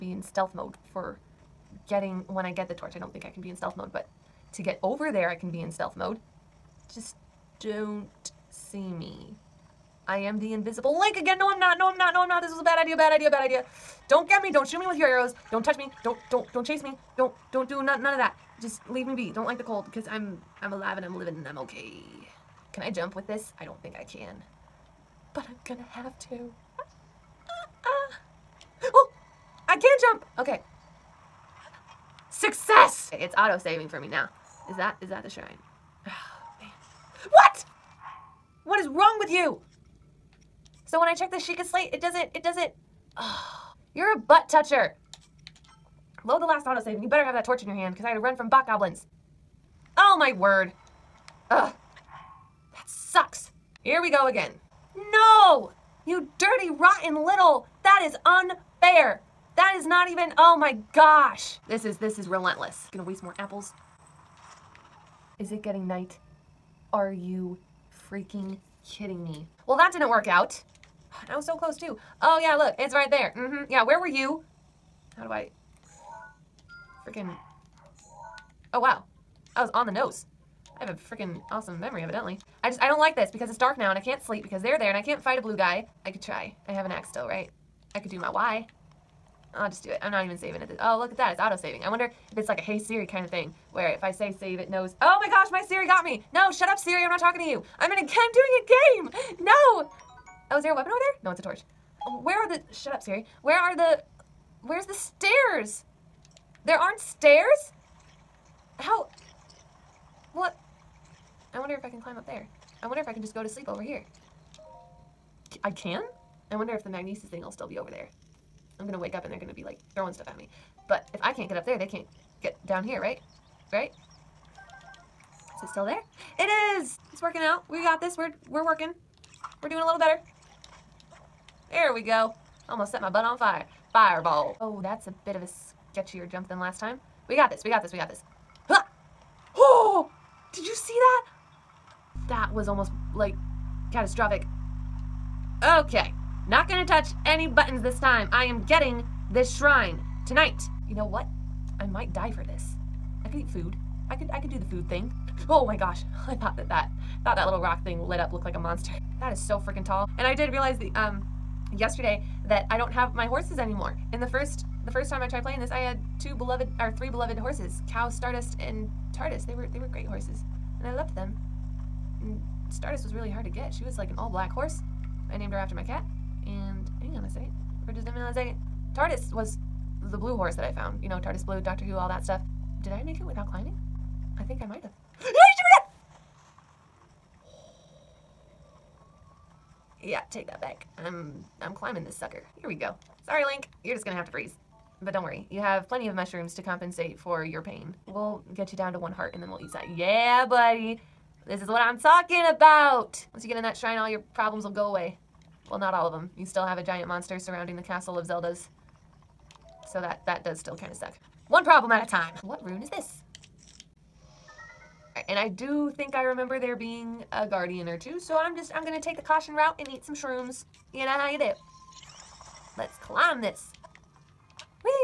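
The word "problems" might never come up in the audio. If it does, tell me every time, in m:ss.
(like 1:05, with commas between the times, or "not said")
3:24, 3:31.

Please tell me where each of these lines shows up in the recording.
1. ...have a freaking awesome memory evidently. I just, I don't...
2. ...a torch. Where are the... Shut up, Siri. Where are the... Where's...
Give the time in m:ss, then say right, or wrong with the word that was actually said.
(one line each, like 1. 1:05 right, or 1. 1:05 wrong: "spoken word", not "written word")
1. 1:20 right
2. 1:41 right.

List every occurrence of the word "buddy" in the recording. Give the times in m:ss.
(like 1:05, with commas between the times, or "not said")
3:20.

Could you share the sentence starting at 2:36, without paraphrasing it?
I thought that that thought that little rock thing lit up looked like a monster.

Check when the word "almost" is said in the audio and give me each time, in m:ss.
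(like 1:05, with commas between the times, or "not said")
2:12, 2:22.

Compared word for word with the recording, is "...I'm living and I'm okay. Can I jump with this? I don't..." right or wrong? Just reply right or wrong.
right.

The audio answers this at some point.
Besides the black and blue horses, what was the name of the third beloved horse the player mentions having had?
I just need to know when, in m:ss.
2:47.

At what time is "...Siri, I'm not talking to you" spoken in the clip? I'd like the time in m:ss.
1:36.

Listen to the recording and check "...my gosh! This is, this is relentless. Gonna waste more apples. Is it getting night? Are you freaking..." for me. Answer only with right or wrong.
right.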